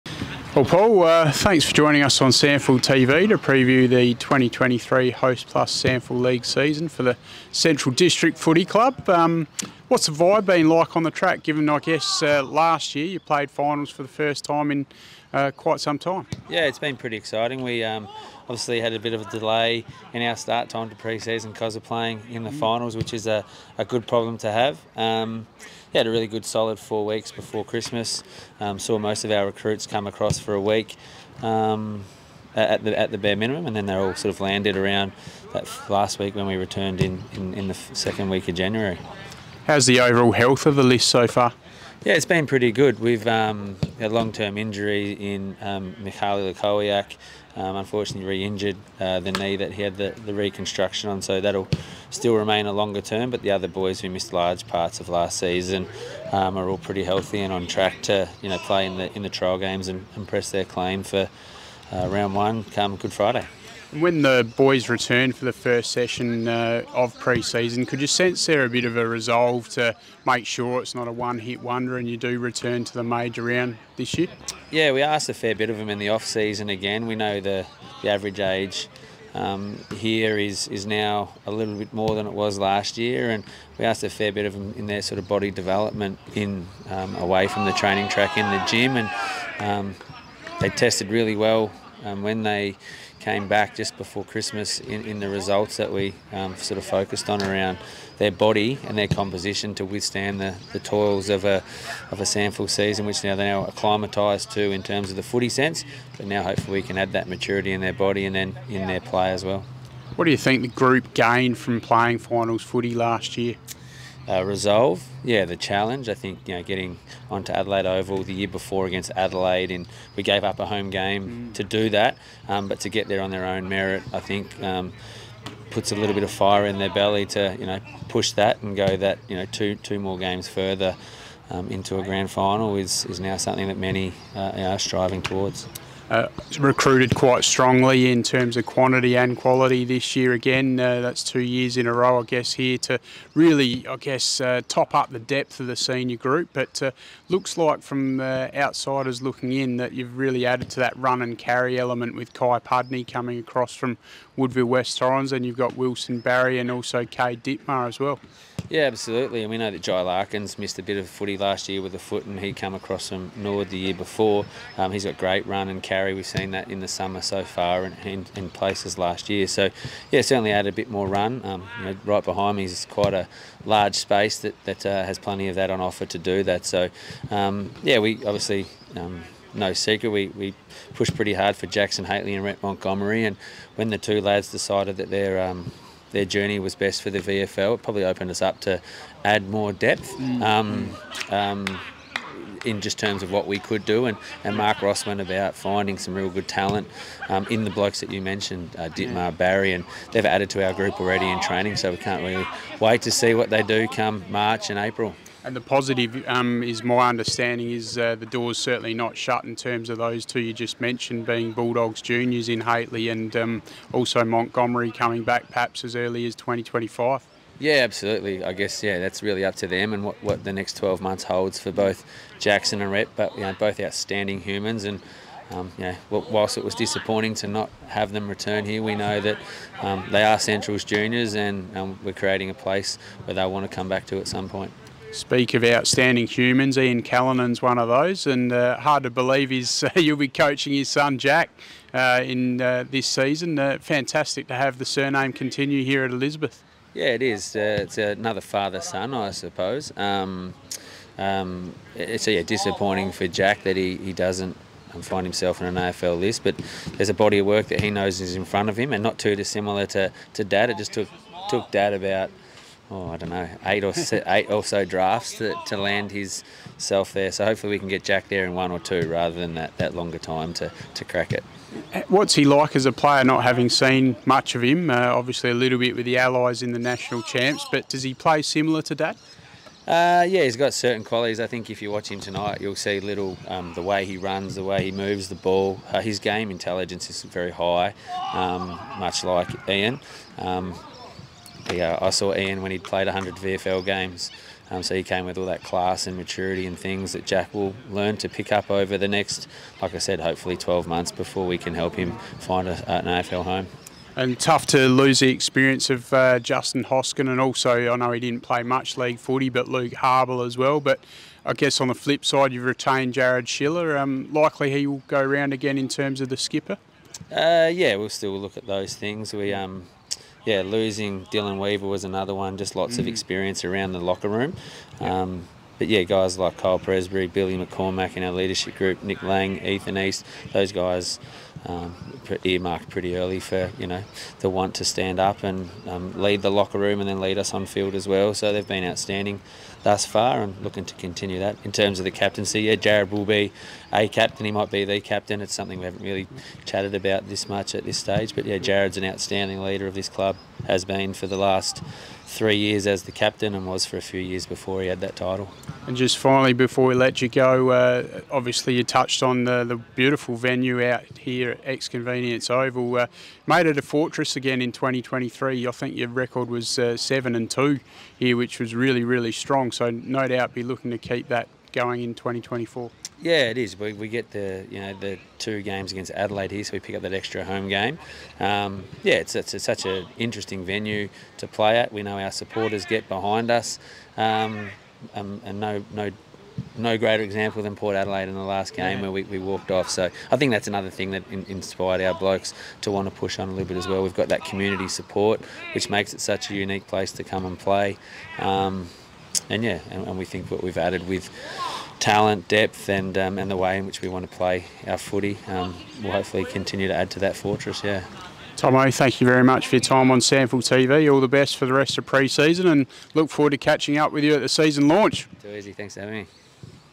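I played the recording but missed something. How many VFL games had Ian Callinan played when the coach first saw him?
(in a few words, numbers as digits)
100.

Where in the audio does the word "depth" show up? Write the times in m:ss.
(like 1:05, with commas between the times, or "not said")
2:25, 3:09, 6:42.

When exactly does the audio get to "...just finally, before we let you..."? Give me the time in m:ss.
5:55.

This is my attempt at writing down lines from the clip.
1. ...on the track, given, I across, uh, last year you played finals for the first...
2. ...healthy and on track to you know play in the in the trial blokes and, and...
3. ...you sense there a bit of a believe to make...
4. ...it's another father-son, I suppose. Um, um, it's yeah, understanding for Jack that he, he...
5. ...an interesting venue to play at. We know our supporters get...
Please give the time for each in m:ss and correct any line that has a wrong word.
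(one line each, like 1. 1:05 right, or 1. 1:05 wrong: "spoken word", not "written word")
1. 0:10 wrong: "guess", not "across"
2. 0:57 wrong: "games", not "blokes"
3. 1:07 wrong: "resolve", not "believe"
4. 4:07 wrong: "disappointing", not "understanding"
5. 6:19 right.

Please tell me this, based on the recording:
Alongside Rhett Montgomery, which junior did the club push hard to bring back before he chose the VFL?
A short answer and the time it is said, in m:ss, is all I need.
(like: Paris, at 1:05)
Jackson Hately, at 3:01.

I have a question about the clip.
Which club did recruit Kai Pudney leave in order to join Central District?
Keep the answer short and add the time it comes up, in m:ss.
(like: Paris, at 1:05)
Woodville West Torrens, at 2:34.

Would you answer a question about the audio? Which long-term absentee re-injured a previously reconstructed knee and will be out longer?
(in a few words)
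Mikhail Lukowiak.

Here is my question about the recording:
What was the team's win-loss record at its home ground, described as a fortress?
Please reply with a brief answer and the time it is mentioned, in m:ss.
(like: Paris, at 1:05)
7 and 2, at 6:06.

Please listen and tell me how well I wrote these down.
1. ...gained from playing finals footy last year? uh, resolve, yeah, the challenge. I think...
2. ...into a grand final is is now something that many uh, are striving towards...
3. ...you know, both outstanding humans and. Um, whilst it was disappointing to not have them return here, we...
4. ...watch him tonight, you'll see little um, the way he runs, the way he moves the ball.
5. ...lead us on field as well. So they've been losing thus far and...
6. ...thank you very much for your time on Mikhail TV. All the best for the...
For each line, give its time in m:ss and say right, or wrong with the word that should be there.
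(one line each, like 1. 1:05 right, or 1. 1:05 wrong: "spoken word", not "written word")
1. 1:51 right
2. 2:11 right
3. 3:43 right
4. 4:41 right
5. 5:37 wrong: "outstanding", not "losing"
6. 6:48 wrong: "SANFL", not "Mikhail".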